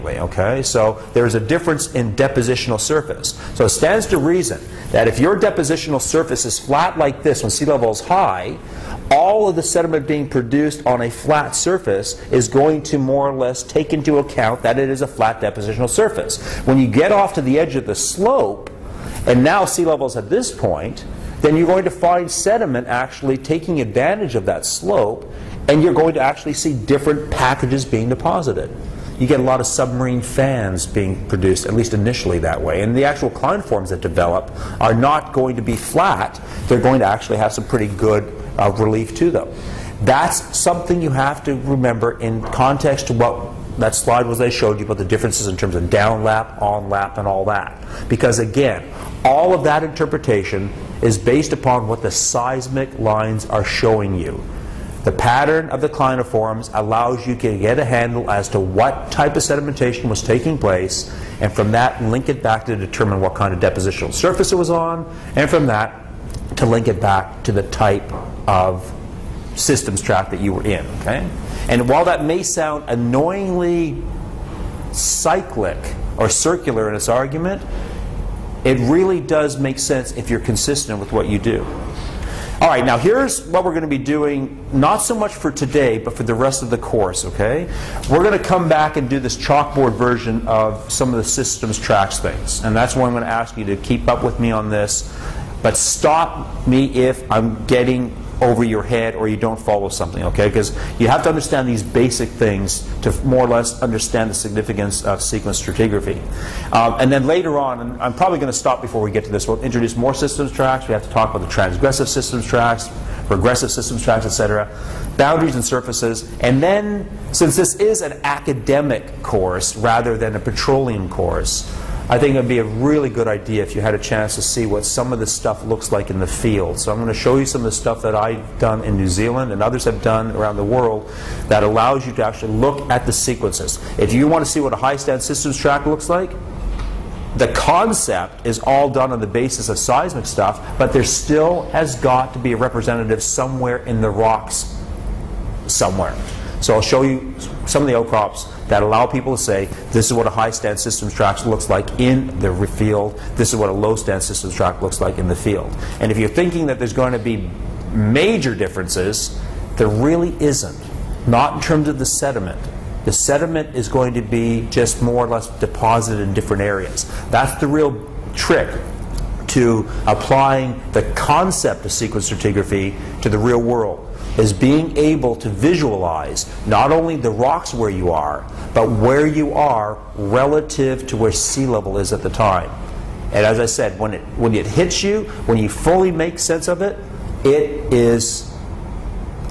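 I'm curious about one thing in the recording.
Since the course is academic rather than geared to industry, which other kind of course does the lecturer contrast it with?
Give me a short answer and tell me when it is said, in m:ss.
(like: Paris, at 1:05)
petroleum course, at 2:00.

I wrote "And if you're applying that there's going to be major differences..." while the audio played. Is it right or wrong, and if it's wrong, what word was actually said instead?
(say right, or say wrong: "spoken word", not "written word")
wrong: "thinking", not "applying".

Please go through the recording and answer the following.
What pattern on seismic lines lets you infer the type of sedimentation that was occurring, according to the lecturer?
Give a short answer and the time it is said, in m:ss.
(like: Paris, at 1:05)
clinoforms, at 0:55.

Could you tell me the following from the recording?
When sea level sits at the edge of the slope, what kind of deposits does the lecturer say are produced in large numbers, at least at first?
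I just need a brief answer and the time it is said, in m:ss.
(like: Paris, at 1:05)
submarine fans, at 0:29.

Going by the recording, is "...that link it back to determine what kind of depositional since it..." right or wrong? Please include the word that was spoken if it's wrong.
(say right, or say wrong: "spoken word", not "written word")
wrong: "surface", not "since".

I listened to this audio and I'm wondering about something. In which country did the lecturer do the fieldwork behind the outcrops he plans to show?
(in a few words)
New Zealand.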